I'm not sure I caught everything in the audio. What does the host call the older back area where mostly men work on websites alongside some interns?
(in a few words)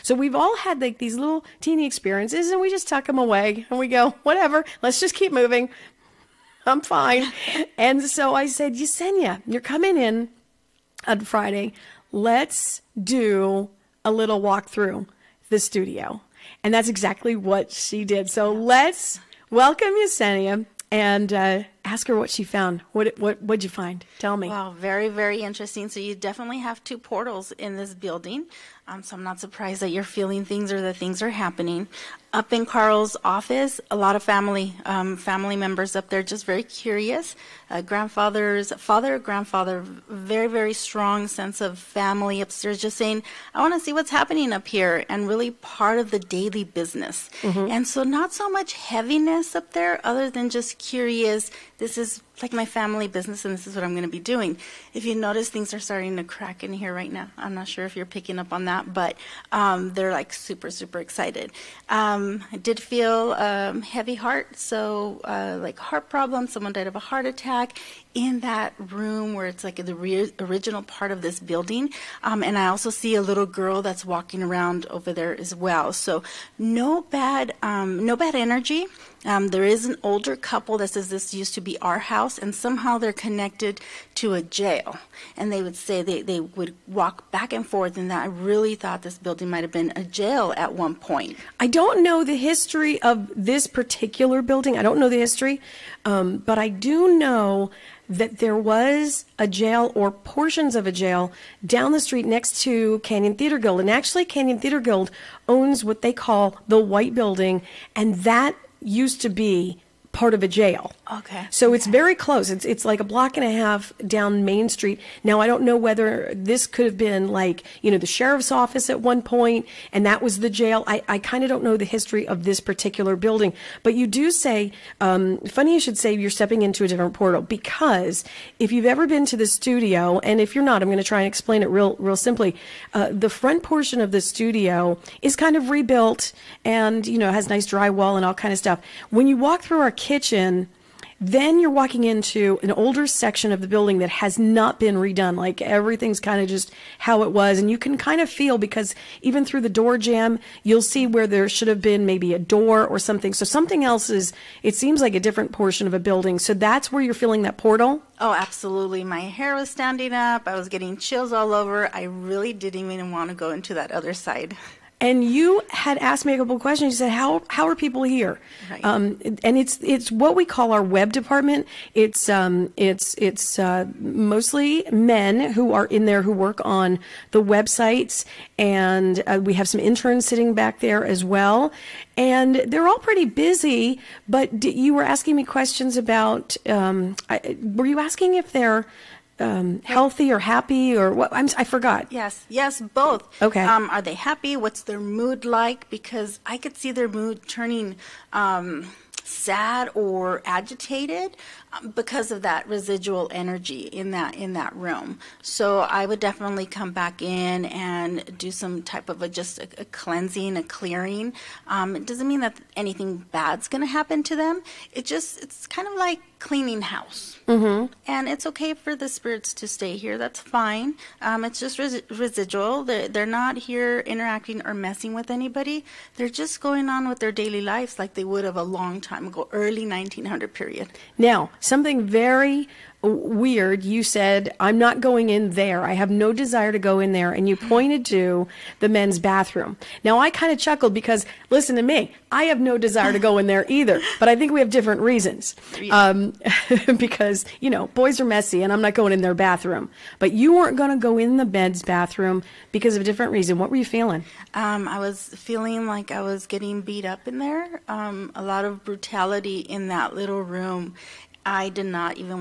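web department.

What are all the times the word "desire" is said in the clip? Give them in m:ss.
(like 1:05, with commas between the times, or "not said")
3:56, 4:02.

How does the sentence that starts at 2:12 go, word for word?
Uh, the front portion of the studio is kind of rebuilt and, you know, has nice drywall and all kind of stuff.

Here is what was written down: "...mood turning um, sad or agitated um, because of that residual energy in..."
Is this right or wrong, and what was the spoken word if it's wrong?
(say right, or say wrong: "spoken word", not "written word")
right.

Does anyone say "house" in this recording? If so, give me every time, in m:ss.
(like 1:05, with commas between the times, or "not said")
1:21, 3:36.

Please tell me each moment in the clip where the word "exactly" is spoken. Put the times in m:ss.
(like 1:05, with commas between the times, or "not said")
0:16.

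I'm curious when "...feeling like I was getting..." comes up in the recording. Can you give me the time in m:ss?
4:15.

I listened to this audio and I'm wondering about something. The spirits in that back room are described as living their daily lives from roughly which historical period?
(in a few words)
early 1900s.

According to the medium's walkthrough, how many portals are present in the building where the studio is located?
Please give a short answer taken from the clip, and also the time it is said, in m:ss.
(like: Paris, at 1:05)
2, at 0:26.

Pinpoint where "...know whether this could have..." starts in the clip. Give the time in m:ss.
1:55.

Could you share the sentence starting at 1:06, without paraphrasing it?
Someone died of a heart attack in that room where it's like the re- original part of this building.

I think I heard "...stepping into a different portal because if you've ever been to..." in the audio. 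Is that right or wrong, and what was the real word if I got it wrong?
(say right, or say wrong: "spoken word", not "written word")
right.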